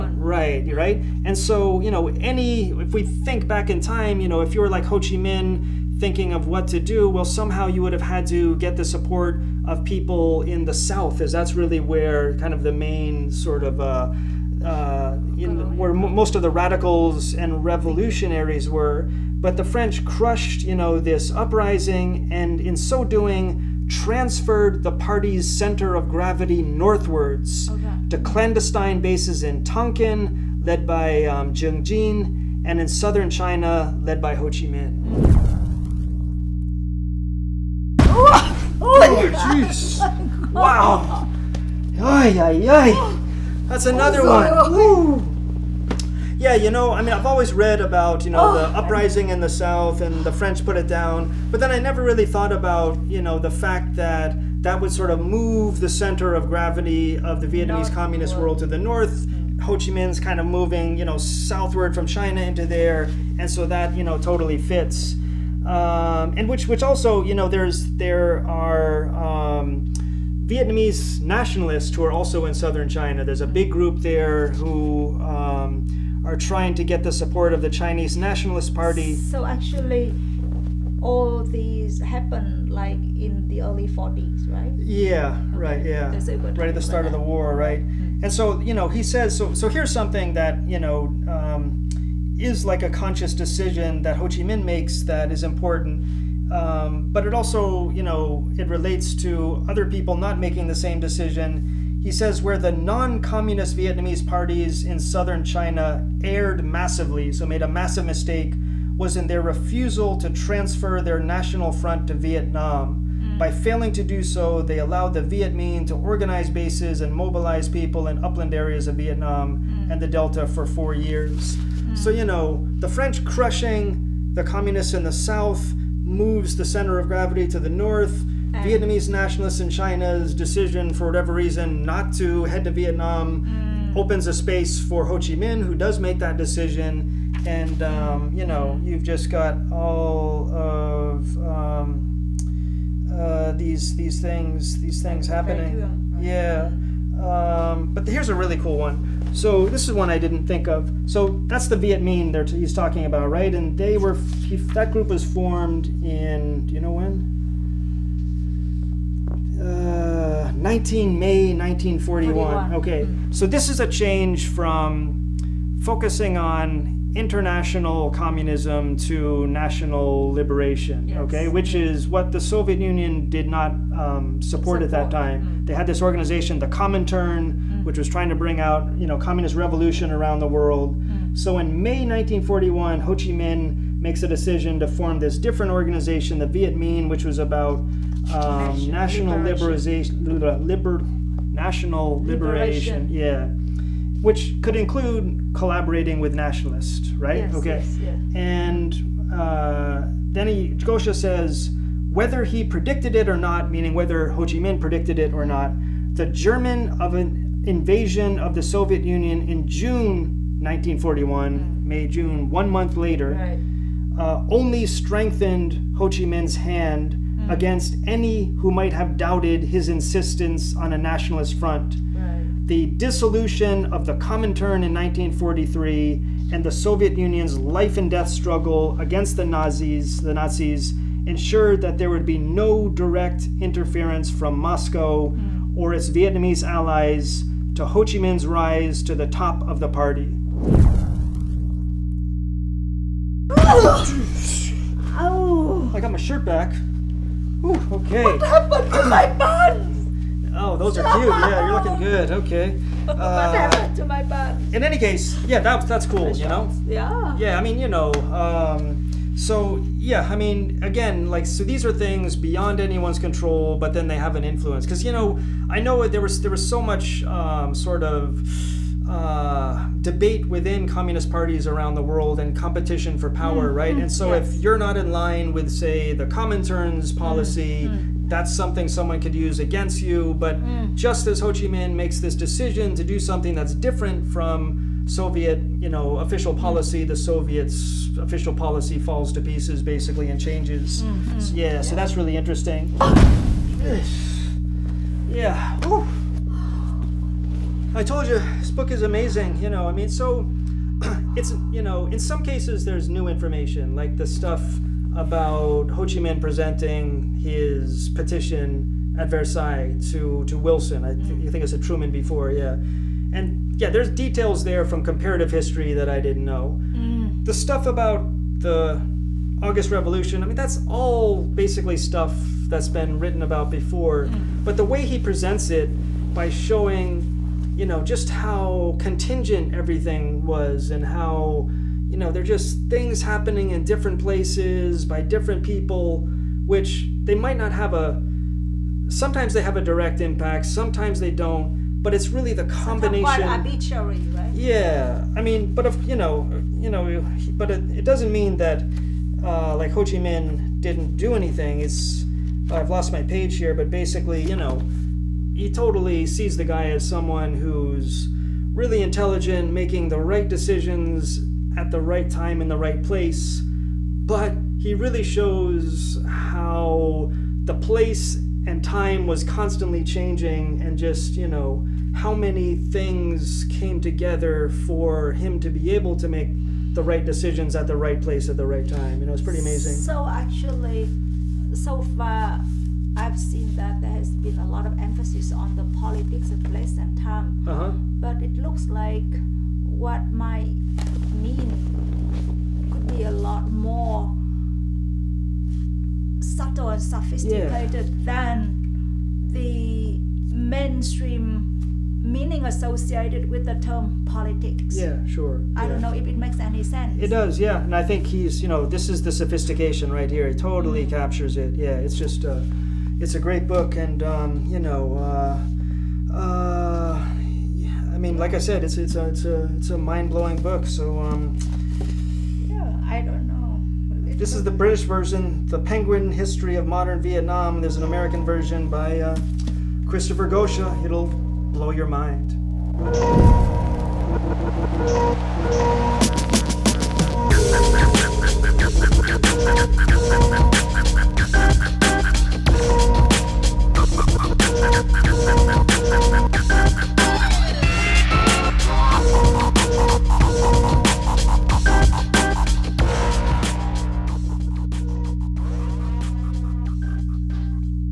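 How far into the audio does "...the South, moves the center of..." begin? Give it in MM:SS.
02:05.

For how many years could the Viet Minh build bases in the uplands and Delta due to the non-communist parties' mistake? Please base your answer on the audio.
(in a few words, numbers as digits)
4 years.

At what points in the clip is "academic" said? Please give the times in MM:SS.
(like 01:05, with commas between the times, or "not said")
not said.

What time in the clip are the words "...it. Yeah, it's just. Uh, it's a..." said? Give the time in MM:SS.
06:51.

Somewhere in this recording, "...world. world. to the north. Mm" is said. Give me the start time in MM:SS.
00:58.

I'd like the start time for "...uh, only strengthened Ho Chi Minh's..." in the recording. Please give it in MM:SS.
03:34.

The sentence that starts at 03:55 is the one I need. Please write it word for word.
or its Vietnamese allies to Ho Chi Minh's rise to the top of the party.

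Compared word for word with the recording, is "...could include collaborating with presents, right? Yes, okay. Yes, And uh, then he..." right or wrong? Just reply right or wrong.
wrong.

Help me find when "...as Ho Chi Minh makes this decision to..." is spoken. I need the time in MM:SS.
04:41.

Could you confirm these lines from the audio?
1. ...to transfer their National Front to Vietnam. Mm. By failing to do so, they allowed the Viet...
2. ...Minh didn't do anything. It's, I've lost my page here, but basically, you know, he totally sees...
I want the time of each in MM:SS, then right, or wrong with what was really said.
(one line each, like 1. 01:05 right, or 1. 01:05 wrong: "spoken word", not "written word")
1. 01:50 right
2. 05:50 right.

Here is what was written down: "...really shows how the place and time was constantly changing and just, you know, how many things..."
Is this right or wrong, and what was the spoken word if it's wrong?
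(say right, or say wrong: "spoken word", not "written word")
right.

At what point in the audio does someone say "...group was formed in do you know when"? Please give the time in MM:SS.
02:34.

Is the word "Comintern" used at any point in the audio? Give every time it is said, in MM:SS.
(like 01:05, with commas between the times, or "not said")
02:56, 03:44, 04:36.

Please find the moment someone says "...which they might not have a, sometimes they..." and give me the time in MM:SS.
05:36.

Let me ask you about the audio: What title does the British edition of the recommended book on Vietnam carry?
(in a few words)
The Penguin History of Modern Vietnam.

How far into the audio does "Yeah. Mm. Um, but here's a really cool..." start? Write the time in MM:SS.
02:26.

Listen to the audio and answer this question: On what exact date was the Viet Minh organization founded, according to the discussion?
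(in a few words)
19 May 1941.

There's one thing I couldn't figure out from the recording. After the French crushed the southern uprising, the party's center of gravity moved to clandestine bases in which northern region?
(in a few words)
Tonkin.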